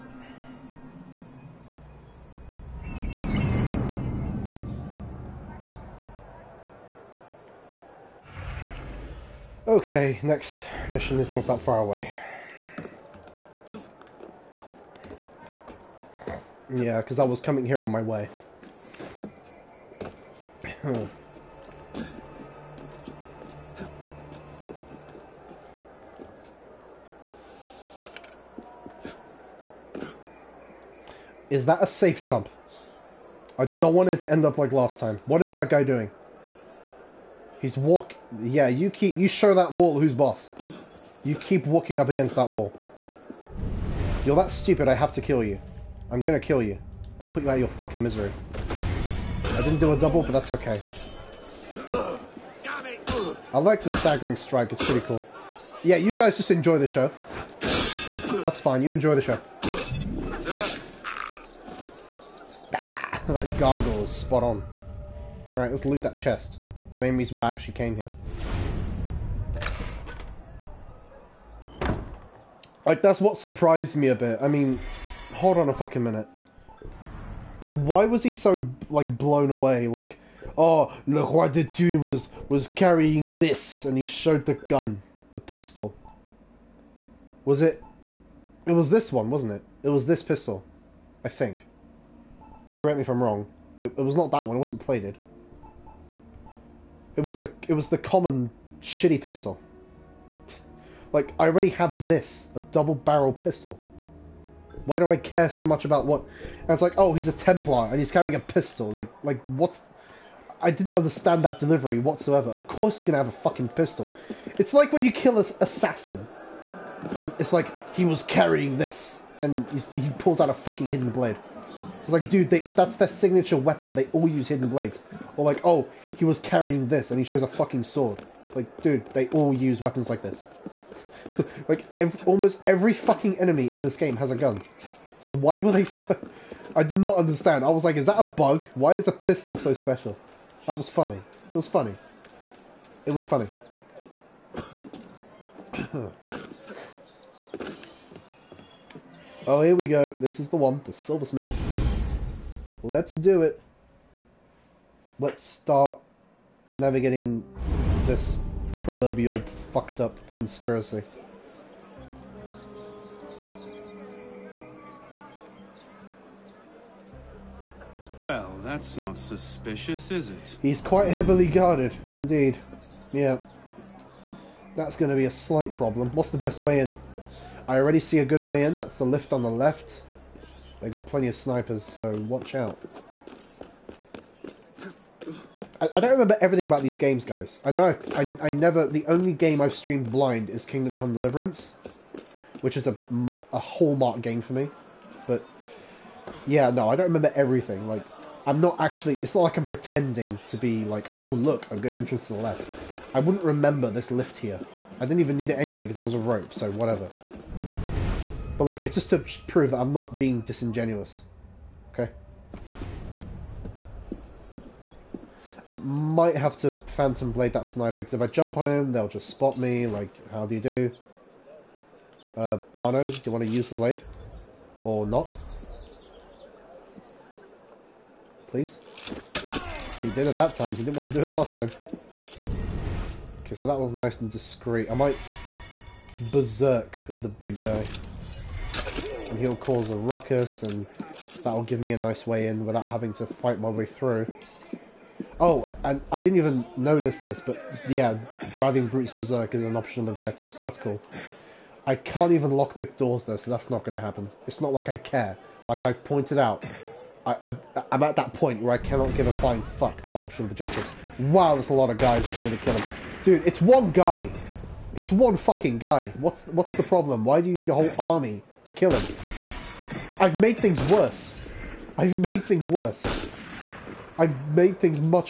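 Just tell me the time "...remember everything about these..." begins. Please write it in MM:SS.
03:06.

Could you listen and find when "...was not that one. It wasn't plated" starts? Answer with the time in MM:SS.
01:34.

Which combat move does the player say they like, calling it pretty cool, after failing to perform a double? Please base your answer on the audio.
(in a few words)
Staggering strike.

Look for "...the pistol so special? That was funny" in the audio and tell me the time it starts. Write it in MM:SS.
02:19.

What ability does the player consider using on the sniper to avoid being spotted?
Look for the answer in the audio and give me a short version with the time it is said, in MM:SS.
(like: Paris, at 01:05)
Phantom Blade, at 03:36.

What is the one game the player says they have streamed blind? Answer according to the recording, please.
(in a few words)
Kingdom Come Deliverance.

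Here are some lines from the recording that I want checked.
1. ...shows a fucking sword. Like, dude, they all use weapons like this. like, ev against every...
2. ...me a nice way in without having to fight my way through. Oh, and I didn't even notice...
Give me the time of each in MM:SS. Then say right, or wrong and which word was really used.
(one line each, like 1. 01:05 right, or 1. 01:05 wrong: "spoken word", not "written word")
1. 02:07 wrong: "almost", not "against"
2. 04:01 right.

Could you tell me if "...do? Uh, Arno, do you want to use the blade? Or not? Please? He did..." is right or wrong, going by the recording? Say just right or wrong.
right.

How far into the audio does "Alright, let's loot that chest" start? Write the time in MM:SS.
01:05.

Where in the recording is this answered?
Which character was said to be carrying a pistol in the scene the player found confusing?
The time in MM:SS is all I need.
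01:21.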